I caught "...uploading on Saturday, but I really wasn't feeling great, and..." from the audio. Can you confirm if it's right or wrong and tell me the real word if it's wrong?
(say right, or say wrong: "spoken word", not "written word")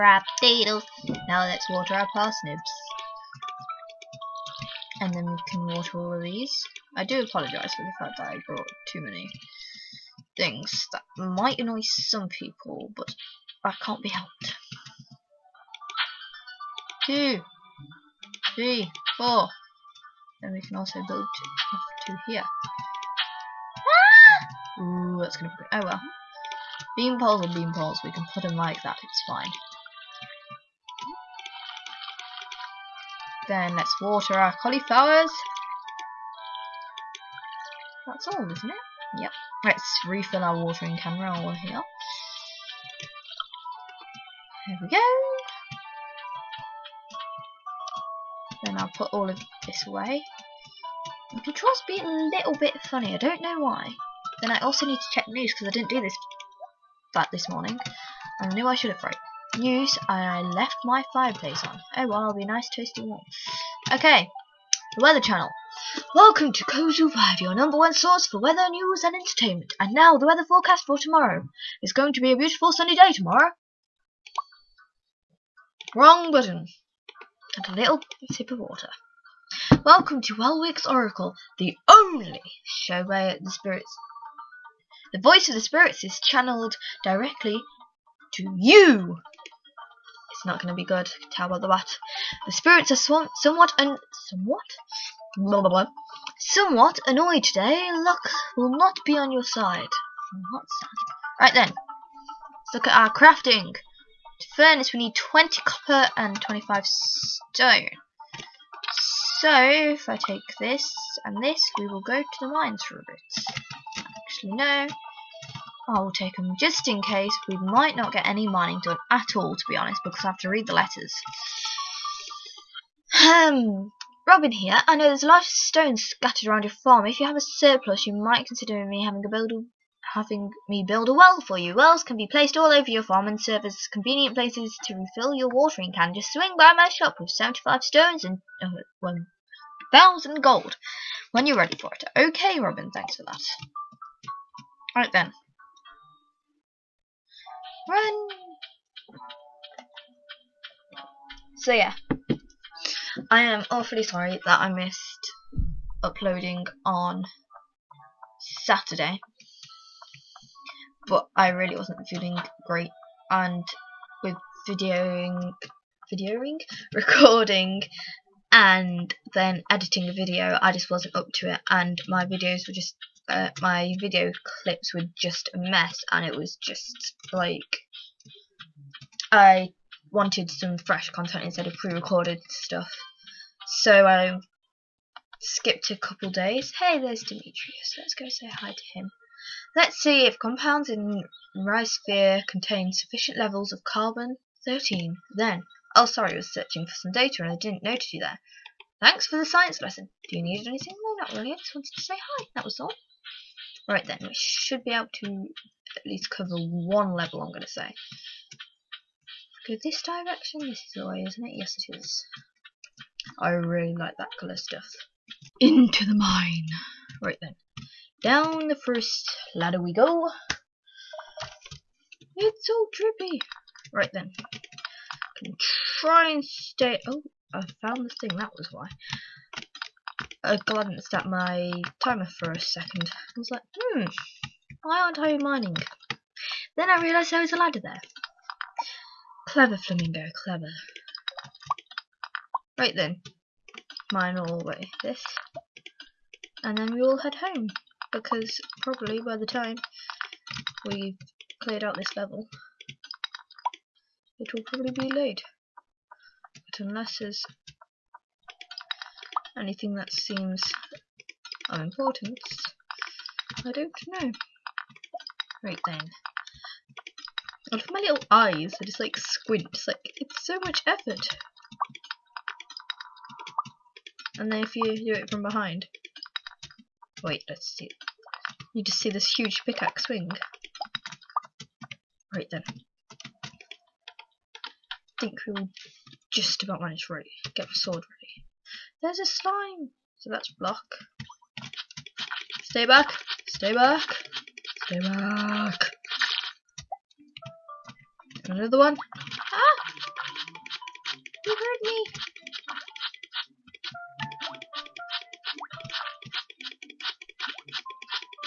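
right.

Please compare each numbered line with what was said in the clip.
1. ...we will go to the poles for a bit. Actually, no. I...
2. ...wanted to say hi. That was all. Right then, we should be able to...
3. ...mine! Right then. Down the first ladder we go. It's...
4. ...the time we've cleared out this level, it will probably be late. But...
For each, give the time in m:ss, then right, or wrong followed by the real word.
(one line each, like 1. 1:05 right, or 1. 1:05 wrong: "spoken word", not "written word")
1. 1:51 wrong: "mines", not "poles"
2. 3:21 right
3. 3:36 right
4. 4:09 right.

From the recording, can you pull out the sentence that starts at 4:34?
And then if you do it from behind, wait, let's see, you just see this huge pickaxe swing.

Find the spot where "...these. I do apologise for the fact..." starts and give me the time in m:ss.
0:06.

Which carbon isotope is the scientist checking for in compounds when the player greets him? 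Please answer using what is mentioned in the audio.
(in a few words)
Carbon-13.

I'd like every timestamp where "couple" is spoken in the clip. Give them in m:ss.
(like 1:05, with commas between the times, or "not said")
3:05.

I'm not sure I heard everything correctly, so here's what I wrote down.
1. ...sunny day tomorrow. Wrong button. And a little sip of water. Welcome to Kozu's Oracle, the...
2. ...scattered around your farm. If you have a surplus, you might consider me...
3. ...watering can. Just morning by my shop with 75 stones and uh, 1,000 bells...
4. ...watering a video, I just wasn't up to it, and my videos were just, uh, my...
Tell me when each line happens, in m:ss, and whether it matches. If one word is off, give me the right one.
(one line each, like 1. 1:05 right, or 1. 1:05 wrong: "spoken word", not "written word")
1. 1:12 wrong: "Welwick", not "Kozu"
2. 2:06 right
3. 2:15 wrong: "swing", not "morning"
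4. 2:49 wrong: "editing", not "watering".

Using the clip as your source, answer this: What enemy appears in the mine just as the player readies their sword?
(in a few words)
A slime.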